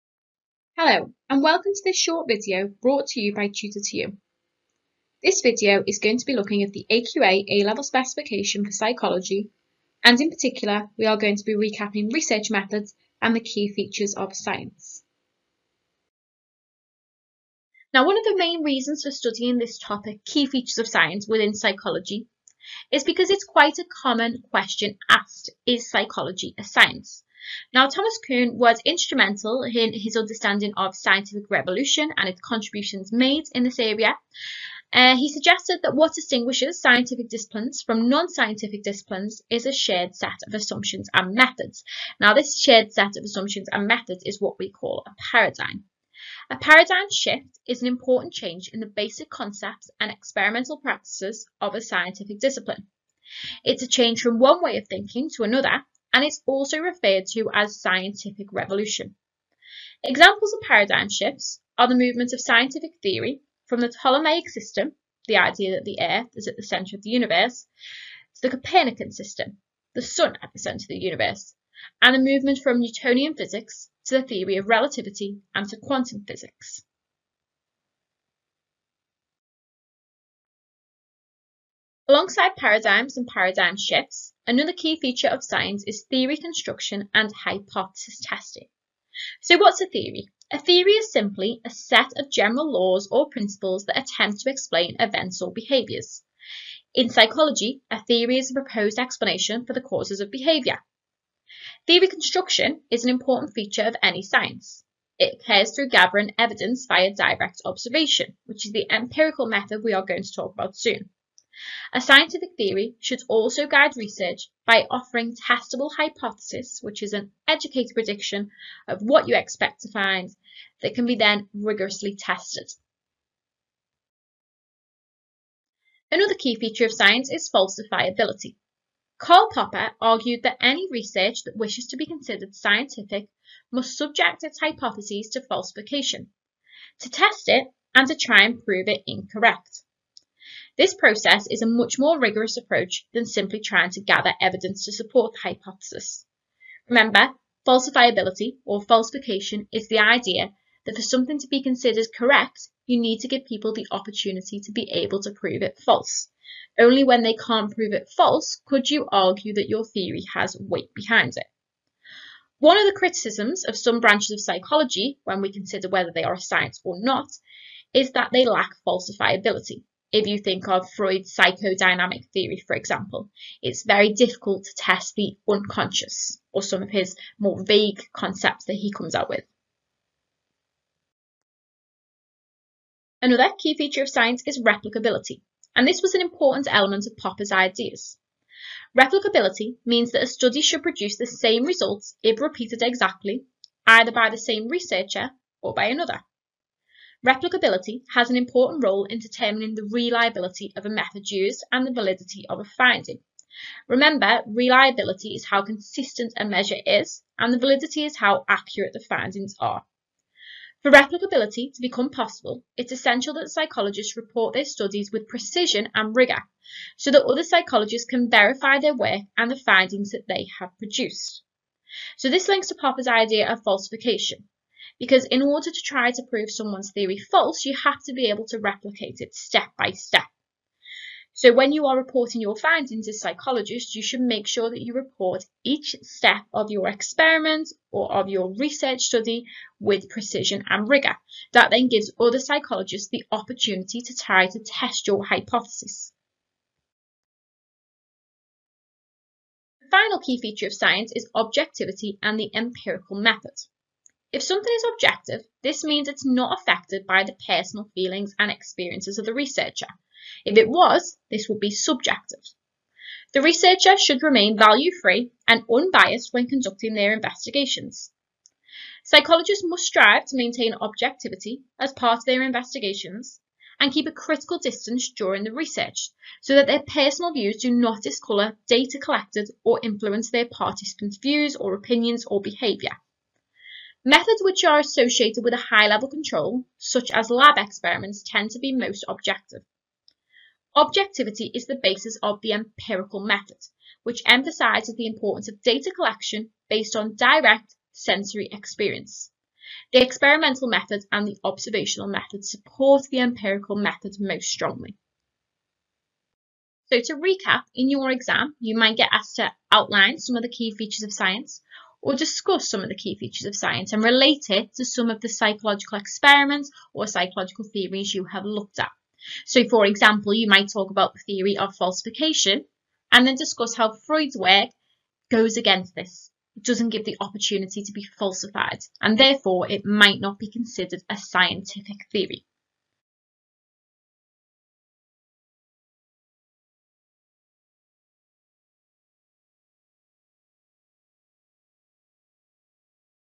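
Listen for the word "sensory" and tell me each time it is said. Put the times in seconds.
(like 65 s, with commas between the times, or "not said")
297 s.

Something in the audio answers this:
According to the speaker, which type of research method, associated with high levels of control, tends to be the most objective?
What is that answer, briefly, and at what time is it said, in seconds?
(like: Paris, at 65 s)
Lab experiments, at 287 s.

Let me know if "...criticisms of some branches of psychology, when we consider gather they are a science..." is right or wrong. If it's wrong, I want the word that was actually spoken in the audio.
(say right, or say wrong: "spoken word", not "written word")
wrong: "whether", not "gather".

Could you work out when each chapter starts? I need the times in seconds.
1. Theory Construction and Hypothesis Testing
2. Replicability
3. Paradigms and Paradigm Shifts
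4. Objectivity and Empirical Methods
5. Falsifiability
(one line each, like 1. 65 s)
1. 81 s
2. 182 s
3. 17 s
4. 249 s
5. 125 s.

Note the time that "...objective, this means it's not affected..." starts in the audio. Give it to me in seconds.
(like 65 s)
254 s.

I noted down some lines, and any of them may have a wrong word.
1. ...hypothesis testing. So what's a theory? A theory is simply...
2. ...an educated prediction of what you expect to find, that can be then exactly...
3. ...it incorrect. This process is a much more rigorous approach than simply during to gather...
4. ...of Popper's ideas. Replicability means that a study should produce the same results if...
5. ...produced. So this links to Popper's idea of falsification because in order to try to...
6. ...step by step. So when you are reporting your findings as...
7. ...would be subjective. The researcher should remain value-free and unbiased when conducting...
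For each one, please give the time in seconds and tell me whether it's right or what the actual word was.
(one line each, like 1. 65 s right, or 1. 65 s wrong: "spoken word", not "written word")
1. 87 s right
2. 117 s wrong: "rigorously", not "exactly"
3. 138 s wrong: "trying", not "during"
4. 187 s right
5. 220 s right
6. 229 s right
7. 261 s right.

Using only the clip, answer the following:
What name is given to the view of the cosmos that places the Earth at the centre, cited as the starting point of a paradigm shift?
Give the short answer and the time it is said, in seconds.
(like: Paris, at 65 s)
Ptolemaic system, at 63 s.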